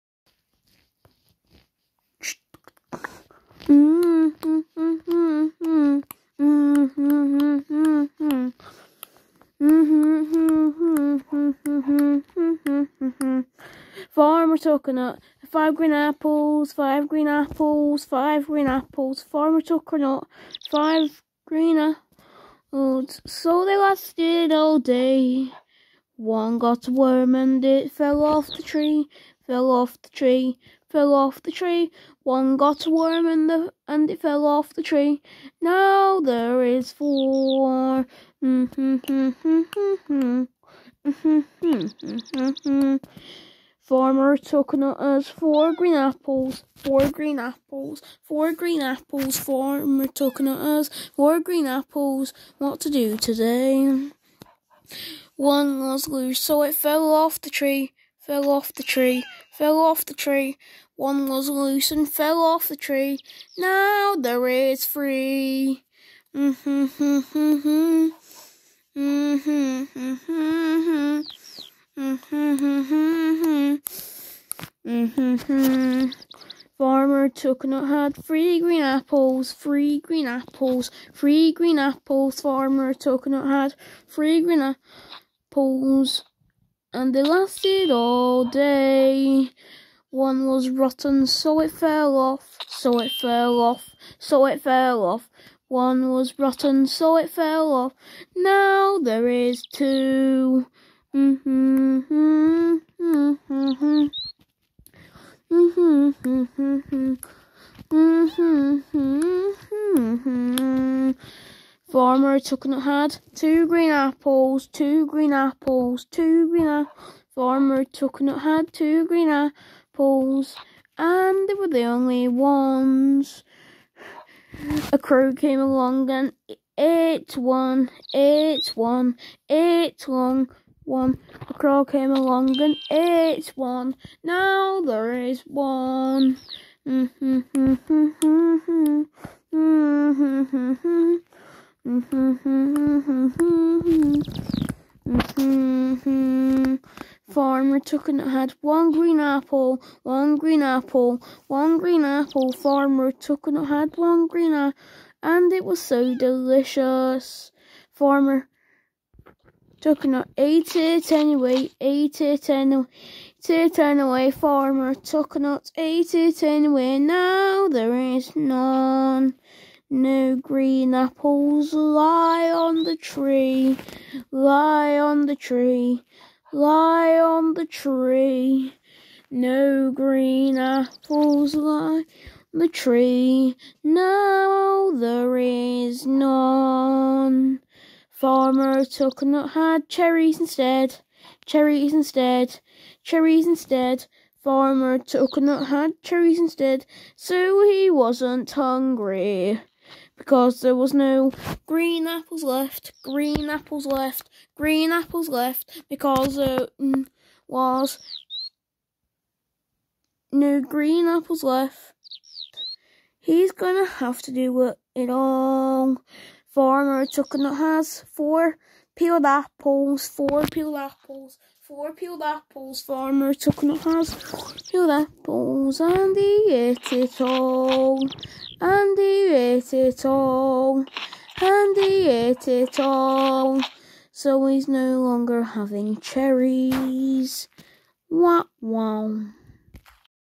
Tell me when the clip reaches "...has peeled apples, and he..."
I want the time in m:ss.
3:43.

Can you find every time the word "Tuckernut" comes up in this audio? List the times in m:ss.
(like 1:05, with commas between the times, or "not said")
0:14, 1:17, 1:22, 3:08, 3:14.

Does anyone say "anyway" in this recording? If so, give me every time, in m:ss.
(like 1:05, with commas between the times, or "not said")
2:41, 2:46.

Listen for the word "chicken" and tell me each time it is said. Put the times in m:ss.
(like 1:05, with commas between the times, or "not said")
3:37, 3:43.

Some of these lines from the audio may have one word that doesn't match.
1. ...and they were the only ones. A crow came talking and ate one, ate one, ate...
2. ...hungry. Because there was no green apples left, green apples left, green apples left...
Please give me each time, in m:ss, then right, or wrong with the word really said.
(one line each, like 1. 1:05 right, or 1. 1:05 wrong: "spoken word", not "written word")
1. 2:00 wrong: "along", not "talking"
2. 3:18 right.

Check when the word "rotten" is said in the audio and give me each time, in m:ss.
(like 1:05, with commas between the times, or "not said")
1:30, 1:36.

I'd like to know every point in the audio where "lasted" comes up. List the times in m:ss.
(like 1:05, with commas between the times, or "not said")
0:23, 1:27.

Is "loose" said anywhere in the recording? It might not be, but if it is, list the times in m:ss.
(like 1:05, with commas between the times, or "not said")
0:56, 1:01.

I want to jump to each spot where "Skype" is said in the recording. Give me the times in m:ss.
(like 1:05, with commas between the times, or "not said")
not said.